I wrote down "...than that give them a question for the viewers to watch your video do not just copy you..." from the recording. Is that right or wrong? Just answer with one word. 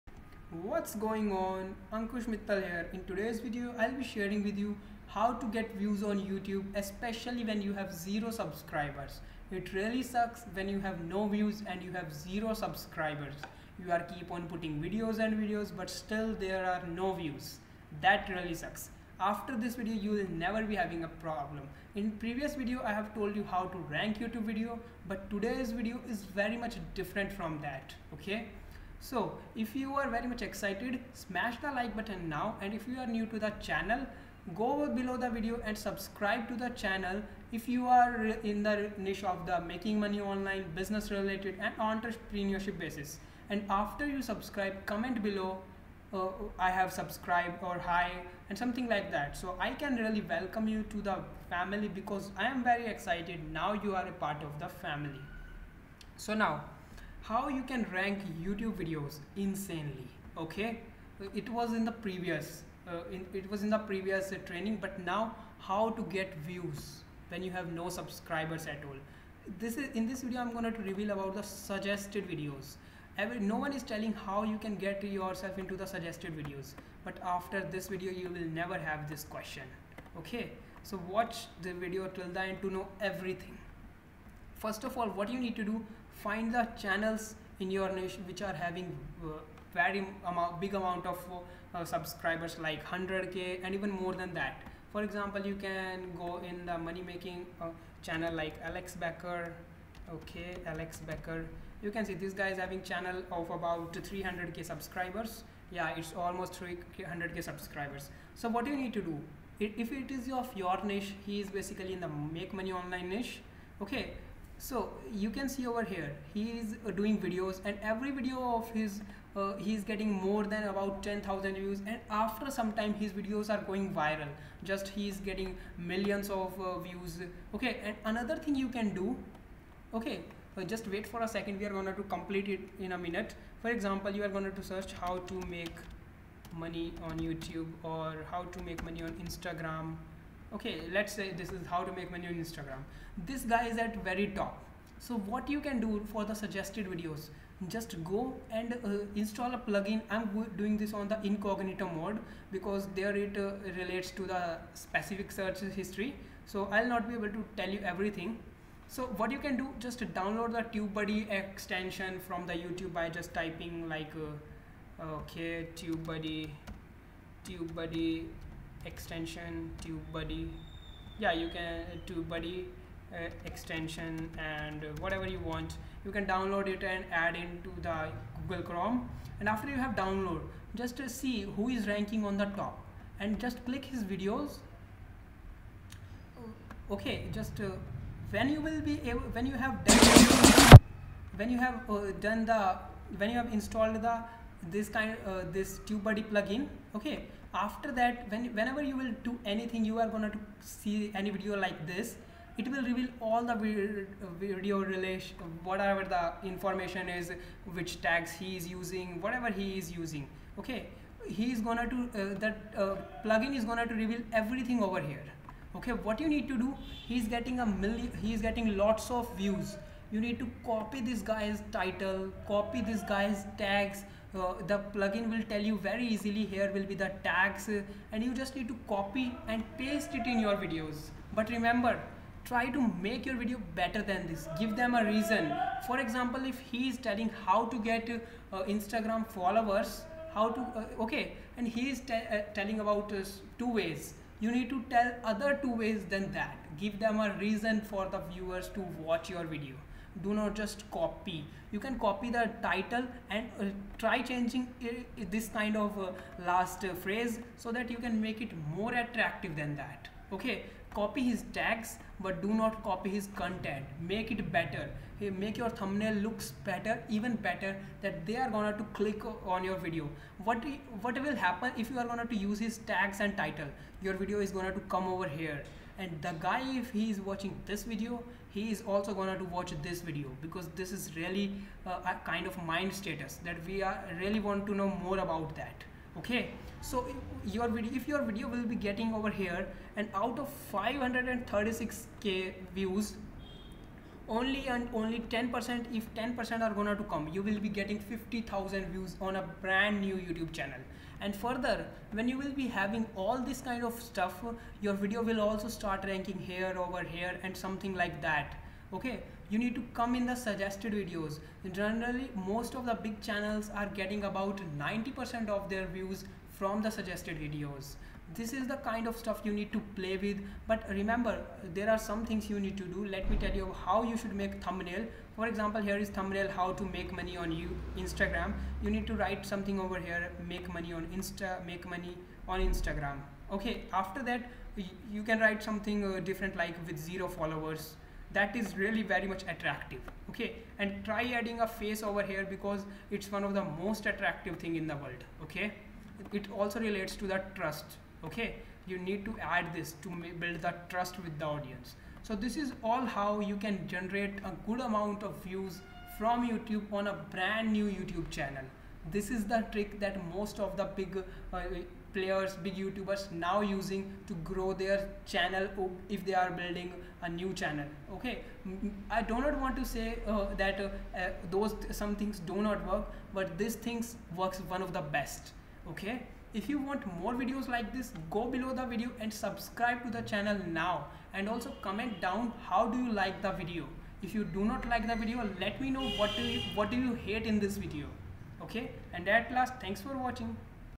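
wrong.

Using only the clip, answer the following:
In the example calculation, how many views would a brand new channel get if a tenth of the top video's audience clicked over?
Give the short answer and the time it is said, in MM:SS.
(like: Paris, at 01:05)
50000, at 04:58.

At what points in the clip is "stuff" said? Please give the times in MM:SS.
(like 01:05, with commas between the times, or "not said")
05:04, 05:19.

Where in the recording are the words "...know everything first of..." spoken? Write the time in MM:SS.
01:22.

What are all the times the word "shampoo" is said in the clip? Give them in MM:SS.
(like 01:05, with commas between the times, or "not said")
not said.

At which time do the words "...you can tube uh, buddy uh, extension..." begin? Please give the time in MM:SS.
02:51.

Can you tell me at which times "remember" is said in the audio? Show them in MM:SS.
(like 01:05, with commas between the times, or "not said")
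03:51, 05:20.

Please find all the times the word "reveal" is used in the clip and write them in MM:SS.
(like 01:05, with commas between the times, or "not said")
01:10, 03:22, 03:33.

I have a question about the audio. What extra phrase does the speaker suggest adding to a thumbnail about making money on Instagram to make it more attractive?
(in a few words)
with zero followers.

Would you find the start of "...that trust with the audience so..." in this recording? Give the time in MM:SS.
05:50.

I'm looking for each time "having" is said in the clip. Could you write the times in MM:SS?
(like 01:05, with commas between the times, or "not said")
00:20, 01:28, 01:42, 05:02.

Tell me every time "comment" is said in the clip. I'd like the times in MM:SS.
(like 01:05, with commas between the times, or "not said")
00:44, 06:21.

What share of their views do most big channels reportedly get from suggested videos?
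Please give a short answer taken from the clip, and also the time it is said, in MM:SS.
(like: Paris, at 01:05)
90%, at 05:14.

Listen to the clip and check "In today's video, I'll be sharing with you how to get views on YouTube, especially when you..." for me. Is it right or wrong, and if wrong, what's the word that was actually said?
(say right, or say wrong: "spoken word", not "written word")
right.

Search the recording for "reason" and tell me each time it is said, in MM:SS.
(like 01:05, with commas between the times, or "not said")
03:55, 04:07.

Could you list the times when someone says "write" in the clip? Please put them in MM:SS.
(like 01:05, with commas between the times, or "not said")
05:29, 05:35.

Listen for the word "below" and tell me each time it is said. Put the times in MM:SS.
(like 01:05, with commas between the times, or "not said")
00:34, 00:45, 06:18.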